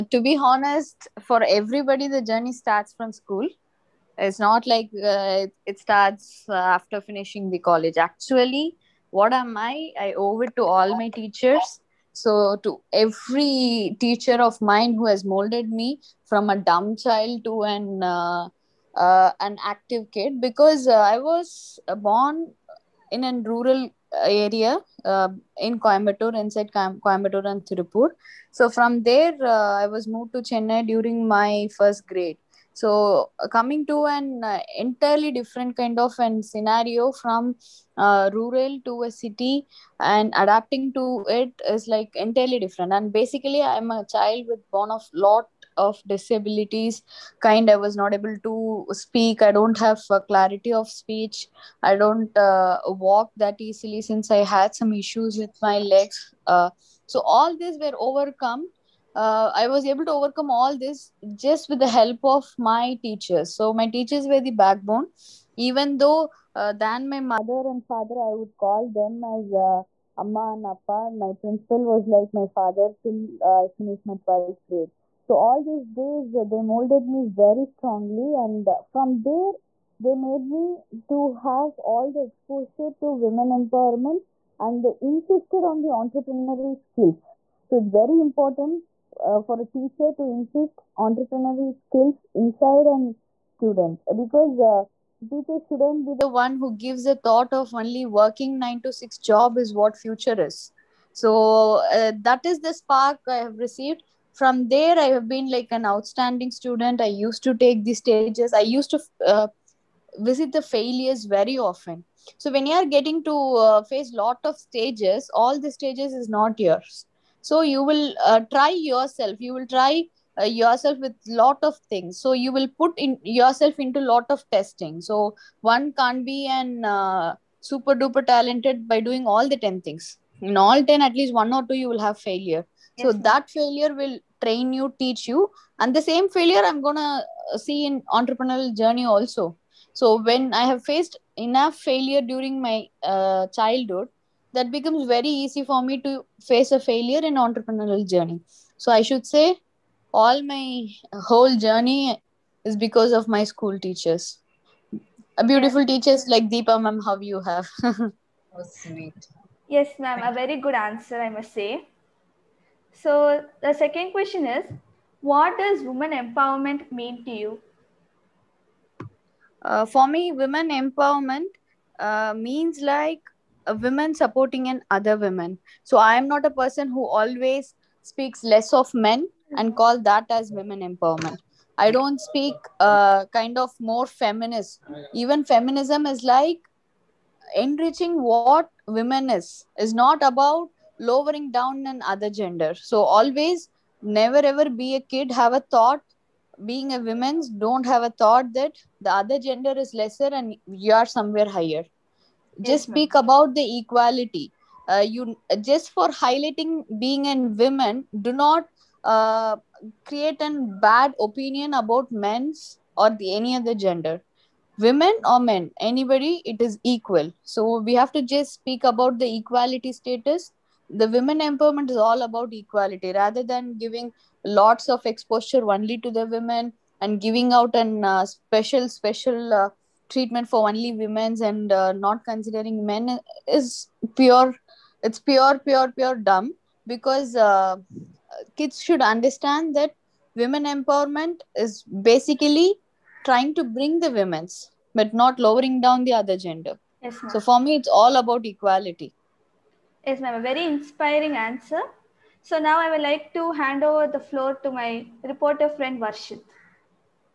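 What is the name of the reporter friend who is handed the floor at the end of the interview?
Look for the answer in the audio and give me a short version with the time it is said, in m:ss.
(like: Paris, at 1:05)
Varshit, at 4:16.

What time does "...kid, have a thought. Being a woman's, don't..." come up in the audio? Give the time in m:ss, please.
3:15.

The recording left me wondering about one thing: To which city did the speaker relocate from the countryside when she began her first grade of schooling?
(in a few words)
Chennai.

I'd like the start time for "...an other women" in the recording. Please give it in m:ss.
2:54.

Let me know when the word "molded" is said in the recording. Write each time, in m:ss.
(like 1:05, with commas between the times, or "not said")
0:15, 1:16.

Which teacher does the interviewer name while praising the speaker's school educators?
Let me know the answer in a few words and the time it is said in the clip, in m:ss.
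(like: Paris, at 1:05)
Deepa, at 2:36.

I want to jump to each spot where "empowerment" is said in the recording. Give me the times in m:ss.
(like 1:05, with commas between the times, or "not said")
1:23, 2:46, 2:50, 3:00, 3:41, 4:00.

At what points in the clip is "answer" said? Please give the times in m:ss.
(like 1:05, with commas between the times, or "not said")
2:40, 4:11.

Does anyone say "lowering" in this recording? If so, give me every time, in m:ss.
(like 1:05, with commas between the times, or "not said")
3:10, 4:05.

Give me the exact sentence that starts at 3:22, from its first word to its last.
Just yes, speak about the equality.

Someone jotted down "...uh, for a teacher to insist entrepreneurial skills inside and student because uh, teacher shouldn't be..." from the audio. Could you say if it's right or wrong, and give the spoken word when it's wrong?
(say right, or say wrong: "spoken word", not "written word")
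right.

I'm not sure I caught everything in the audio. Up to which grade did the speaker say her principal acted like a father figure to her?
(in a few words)
12th grade.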